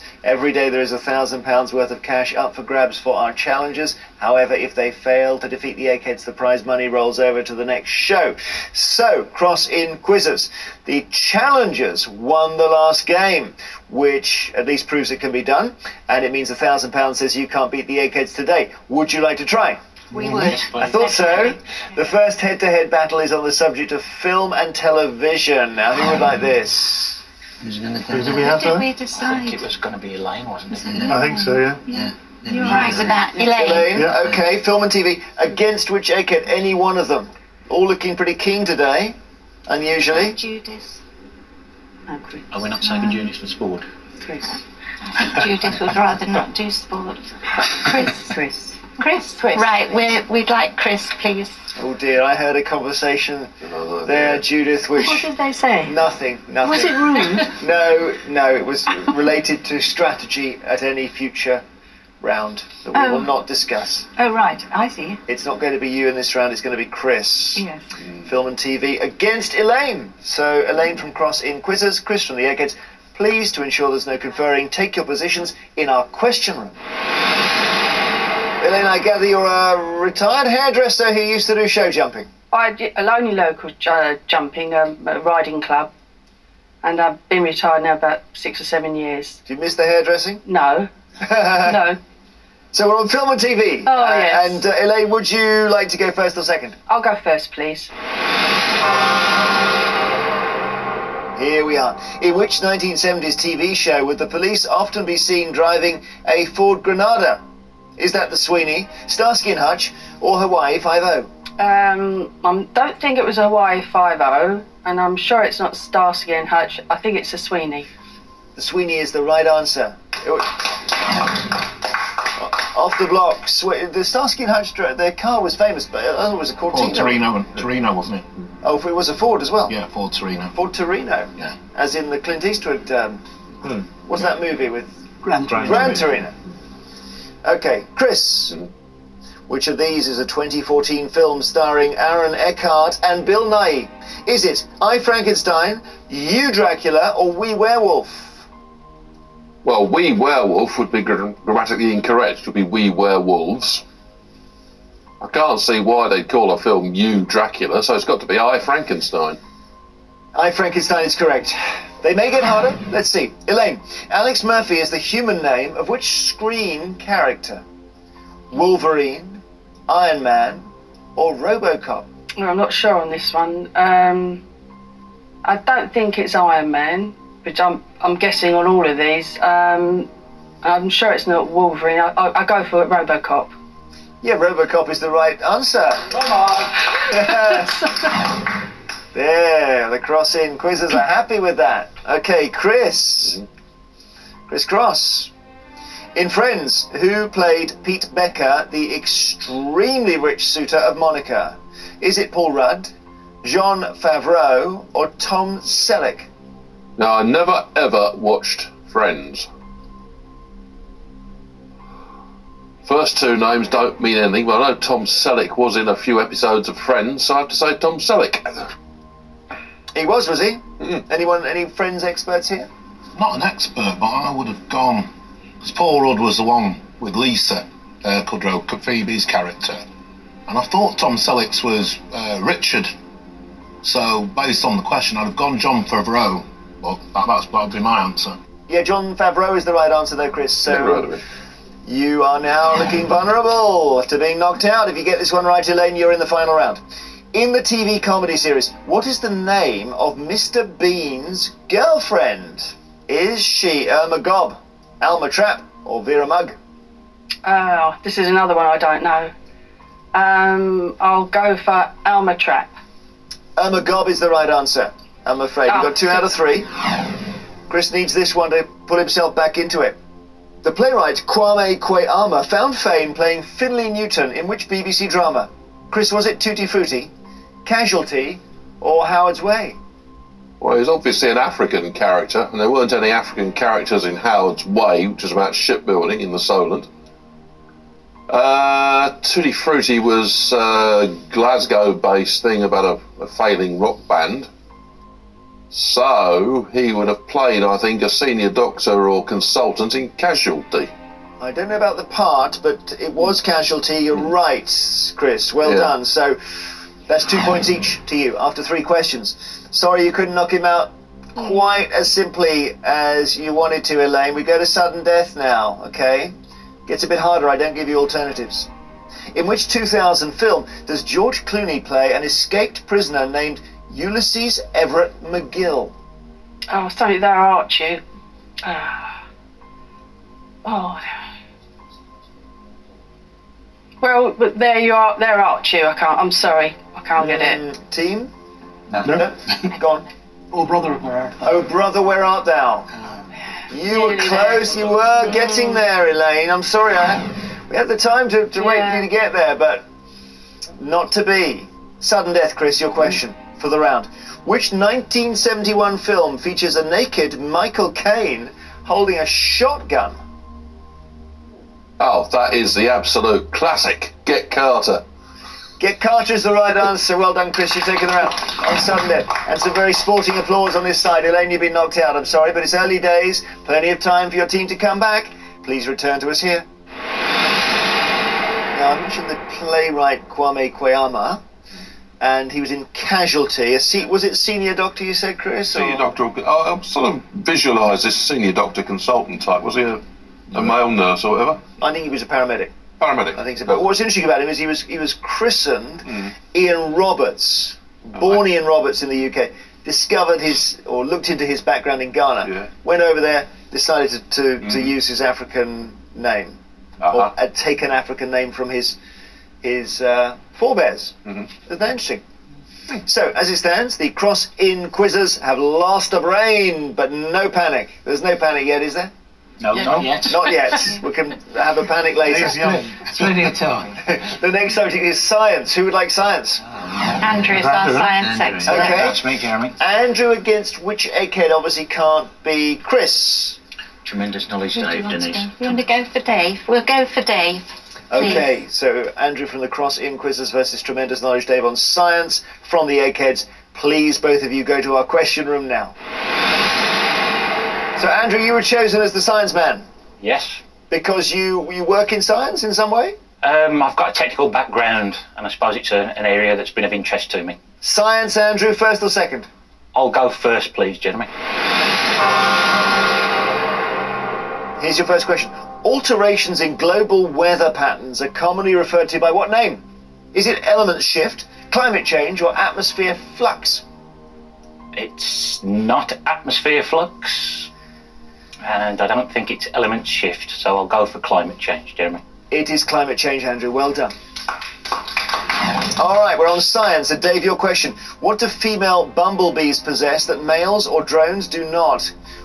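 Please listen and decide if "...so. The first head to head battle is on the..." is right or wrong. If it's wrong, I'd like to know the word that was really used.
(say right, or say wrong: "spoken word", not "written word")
right.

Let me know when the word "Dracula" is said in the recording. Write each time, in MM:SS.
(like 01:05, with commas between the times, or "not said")
02:26, 02:37.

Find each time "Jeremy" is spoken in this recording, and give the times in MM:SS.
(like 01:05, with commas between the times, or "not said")
07:09, 07:40, 08:01.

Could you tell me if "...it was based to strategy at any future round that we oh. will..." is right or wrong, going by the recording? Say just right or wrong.
wrong.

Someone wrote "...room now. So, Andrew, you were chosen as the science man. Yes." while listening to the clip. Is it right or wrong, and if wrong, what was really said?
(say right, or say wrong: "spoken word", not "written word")
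right.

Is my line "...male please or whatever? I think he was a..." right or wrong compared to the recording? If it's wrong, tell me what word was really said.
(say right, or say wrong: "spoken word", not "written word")
wrong: "nurse", not "please".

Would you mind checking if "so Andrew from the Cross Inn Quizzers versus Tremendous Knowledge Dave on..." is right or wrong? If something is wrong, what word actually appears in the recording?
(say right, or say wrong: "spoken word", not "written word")
right.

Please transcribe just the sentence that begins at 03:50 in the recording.
And I thought Tom Selleck's was uh, Richard.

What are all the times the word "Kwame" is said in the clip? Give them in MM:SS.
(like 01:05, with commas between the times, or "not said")
04:31, 06:20.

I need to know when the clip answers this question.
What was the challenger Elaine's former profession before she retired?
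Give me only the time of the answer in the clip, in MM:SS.
01:20.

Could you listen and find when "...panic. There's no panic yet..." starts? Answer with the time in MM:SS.
06:57.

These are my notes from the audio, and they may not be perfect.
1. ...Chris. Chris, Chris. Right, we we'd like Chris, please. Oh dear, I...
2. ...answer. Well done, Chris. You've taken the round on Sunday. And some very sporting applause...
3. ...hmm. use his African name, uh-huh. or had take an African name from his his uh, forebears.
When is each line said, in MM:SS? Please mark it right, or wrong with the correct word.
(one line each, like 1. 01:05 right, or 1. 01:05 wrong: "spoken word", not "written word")
1. 00:48 right
2. 06:06 right
3. 06:44 right.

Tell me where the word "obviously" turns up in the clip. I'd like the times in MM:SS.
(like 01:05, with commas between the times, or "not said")
04:40, 07:11.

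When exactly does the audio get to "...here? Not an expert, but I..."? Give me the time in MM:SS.
03:42.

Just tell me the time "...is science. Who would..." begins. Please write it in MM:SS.
07:05.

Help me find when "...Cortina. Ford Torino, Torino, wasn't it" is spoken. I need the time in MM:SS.
02:06.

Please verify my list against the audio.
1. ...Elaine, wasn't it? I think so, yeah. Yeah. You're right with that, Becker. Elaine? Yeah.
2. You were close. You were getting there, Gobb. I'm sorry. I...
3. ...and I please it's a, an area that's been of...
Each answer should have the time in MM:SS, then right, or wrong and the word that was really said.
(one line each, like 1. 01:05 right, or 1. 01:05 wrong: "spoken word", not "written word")
1. 00:30 wrong: "Elaine", not "Becker"
2. 05:43 wrong: "Elaine", not "Gobb"
3. 07:35 wrong: "suppose", not "please".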